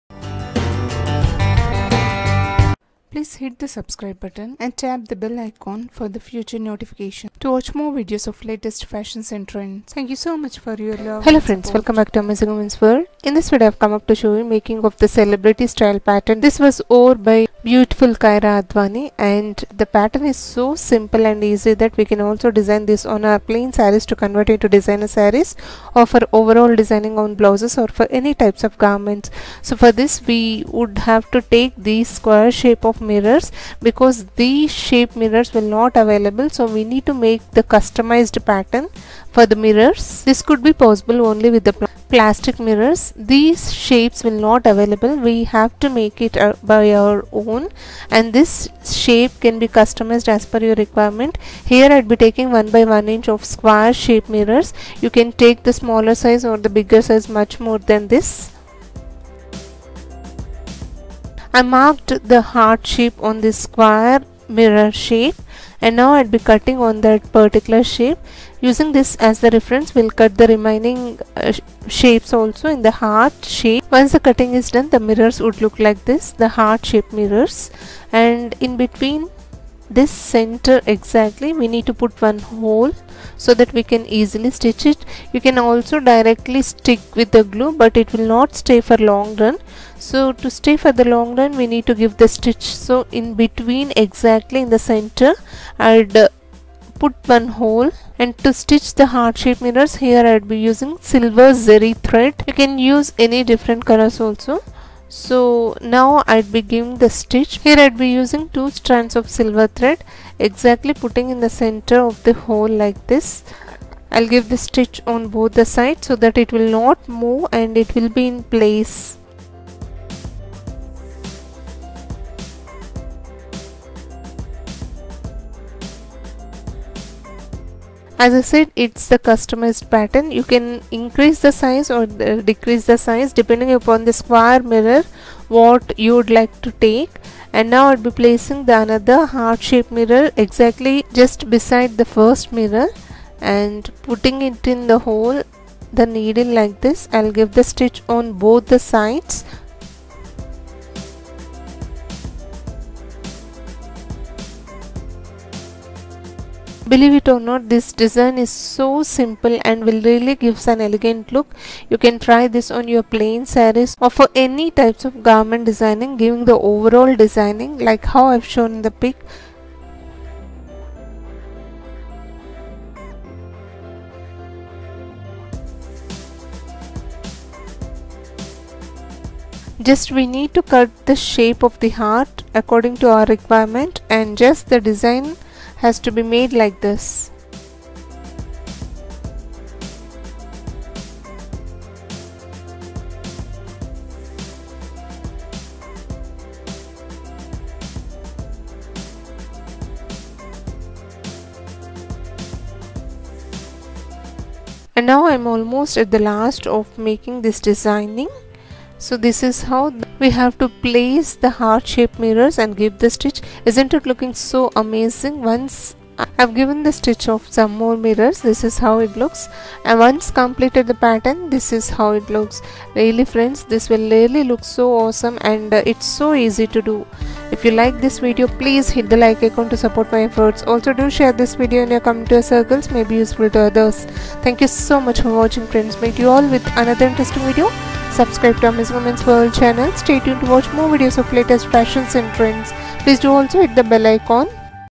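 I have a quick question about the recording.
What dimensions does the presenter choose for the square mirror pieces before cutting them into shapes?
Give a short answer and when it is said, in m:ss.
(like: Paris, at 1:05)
1 by 1 inch, at 0:52.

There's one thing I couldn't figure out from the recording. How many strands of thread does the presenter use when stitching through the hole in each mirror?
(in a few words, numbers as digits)
2.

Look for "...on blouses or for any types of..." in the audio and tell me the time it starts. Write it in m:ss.
0:27.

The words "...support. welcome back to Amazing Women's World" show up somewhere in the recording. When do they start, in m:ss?
0:11.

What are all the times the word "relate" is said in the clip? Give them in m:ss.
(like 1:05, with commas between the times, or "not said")
not said.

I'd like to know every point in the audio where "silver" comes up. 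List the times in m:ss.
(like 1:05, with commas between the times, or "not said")
1:41, 1:49.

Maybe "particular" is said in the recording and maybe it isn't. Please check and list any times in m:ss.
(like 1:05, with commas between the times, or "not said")
1:07.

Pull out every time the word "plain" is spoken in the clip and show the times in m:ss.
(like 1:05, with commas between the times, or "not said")
0:23, 2:43.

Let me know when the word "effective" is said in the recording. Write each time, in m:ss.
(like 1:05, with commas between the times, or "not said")
not said.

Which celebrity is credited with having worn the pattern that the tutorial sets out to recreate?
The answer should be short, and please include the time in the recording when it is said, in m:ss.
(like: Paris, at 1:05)
Kiara Advani, at 0:18.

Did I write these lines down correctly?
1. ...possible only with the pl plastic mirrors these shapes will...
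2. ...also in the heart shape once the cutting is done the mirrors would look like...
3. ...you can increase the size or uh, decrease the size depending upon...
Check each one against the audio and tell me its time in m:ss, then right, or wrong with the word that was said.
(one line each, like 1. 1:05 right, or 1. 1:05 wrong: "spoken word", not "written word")
1. 0:40 right
2. 1:12 right
3. 2:10 right.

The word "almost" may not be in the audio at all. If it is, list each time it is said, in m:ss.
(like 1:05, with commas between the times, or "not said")
3:25.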